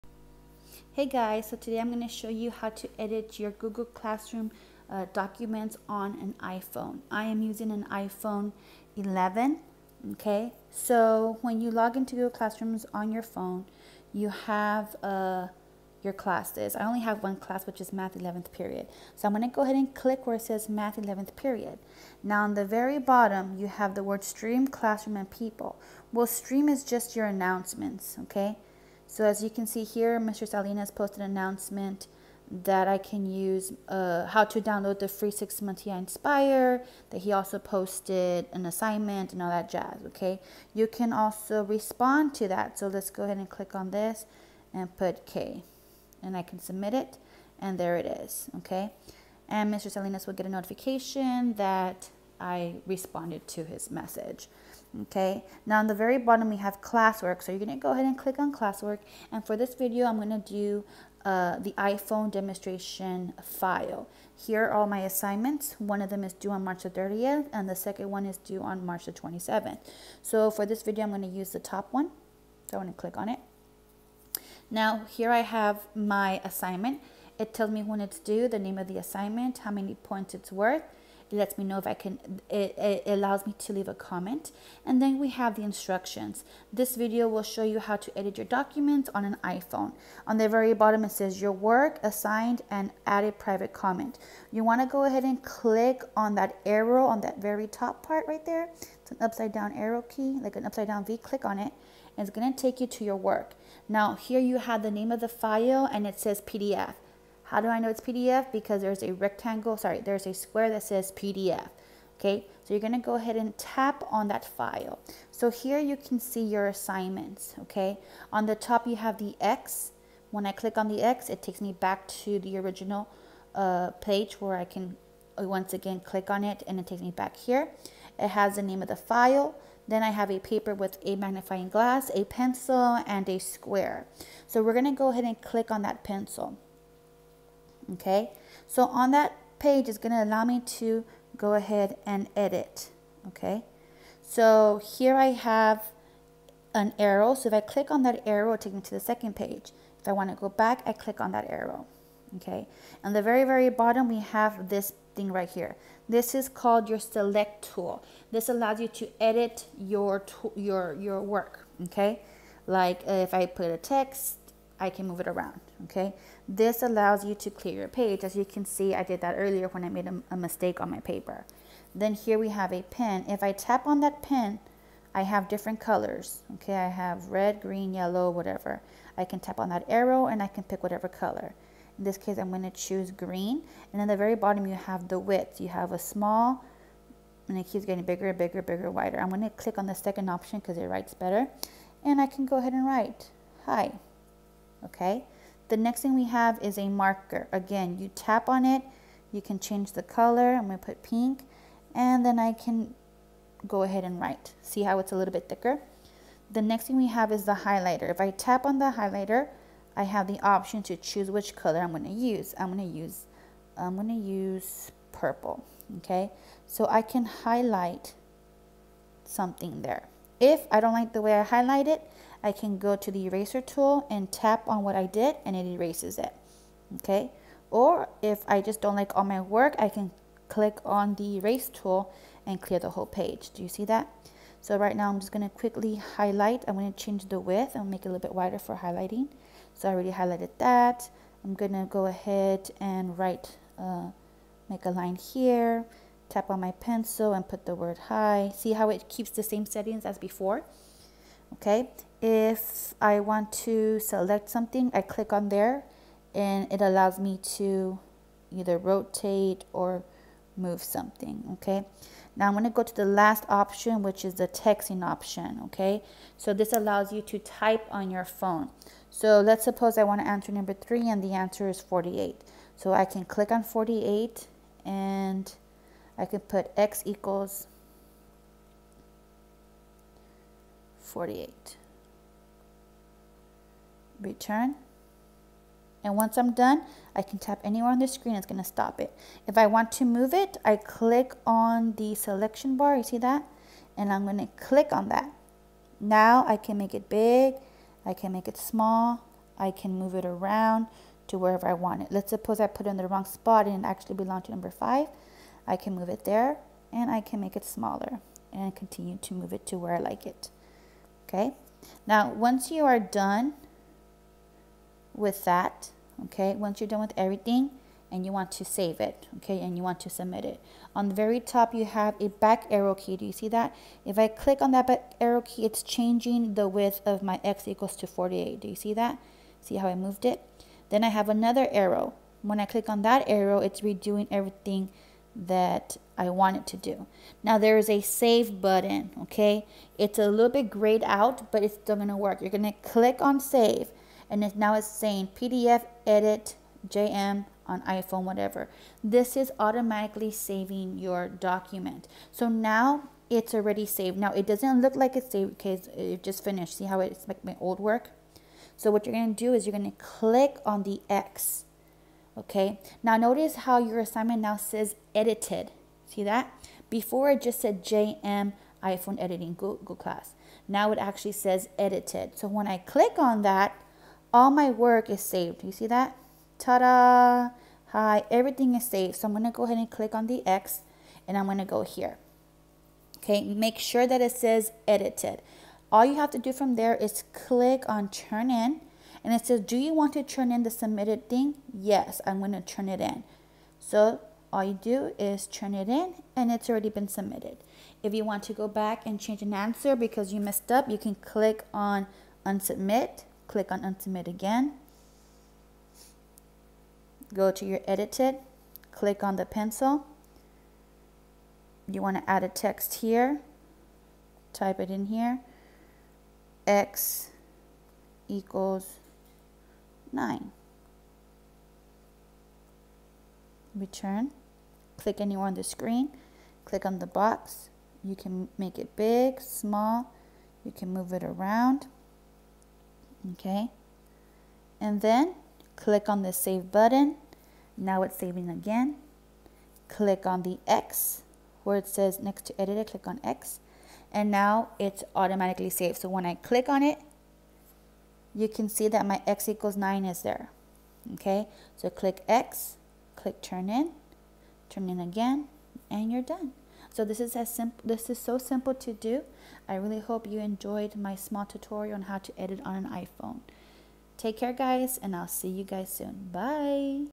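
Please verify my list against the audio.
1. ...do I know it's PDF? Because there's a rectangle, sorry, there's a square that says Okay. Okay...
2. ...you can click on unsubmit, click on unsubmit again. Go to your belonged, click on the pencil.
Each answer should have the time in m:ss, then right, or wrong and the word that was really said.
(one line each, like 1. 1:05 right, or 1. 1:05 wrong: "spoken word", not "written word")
1. 1:47 wrong: "PDF", not "Okay"
2. 6:40 wrong: "edited", not "belonged".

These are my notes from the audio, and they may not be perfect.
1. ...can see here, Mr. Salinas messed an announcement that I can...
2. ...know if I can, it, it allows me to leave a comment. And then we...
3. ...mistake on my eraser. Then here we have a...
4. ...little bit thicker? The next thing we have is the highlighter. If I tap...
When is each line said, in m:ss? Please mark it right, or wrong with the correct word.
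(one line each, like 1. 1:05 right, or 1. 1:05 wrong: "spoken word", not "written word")
1. 0:29 wrong: "posted", not "messed"
2. 1:21 right
3. 2:50 wrong: "paper", not "eraser"
4. 3:25 right.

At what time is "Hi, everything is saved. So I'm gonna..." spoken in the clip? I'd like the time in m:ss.
6:17.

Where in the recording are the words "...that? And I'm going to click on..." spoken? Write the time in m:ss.
4:53.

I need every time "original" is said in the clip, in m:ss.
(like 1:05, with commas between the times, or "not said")
2:02.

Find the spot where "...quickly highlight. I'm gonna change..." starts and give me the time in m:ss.
3:55.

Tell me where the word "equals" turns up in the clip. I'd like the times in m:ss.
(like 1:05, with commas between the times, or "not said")
4:37, 5:27, 6:58, 7:29.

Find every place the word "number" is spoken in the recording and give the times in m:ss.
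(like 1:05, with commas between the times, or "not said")
4:30, 5:04.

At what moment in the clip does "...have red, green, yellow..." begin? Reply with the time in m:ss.
2:56.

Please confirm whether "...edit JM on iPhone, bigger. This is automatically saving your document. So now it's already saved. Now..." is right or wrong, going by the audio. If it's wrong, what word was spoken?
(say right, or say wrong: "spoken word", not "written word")
wrong: "whatever", not "bigger".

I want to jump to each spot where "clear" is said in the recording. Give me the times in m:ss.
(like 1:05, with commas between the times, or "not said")
2:47, 3:52.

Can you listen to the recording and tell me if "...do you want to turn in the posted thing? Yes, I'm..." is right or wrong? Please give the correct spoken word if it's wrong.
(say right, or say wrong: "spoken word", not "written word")
wrong: "submitted", not "posted".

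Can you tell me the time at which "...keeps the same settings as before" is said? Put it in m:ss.
4:09.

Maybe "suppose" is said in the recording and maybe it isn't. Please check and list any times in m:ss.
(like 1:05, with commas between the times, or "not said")
4:29, 5:02.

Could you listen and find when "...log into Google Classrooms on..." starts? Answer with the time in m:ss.
0:11.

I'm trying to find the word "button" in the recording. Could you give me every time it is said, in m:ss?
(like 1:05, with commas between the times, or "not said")
5:38, 7:16.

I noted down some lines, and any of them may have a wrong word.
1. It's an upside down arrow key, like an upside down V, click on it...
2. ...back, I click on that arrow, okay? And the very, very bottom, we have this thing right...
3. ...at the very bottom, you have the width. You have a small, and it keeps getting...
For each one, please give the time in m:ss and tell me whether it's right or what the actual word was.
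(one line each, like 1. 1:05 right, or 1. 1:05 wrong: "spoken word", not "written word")
1. 1:39 right
2. 2:30 right
3. 3:04 right.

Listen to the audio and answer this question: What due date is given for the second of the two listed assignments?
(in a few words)
March 27.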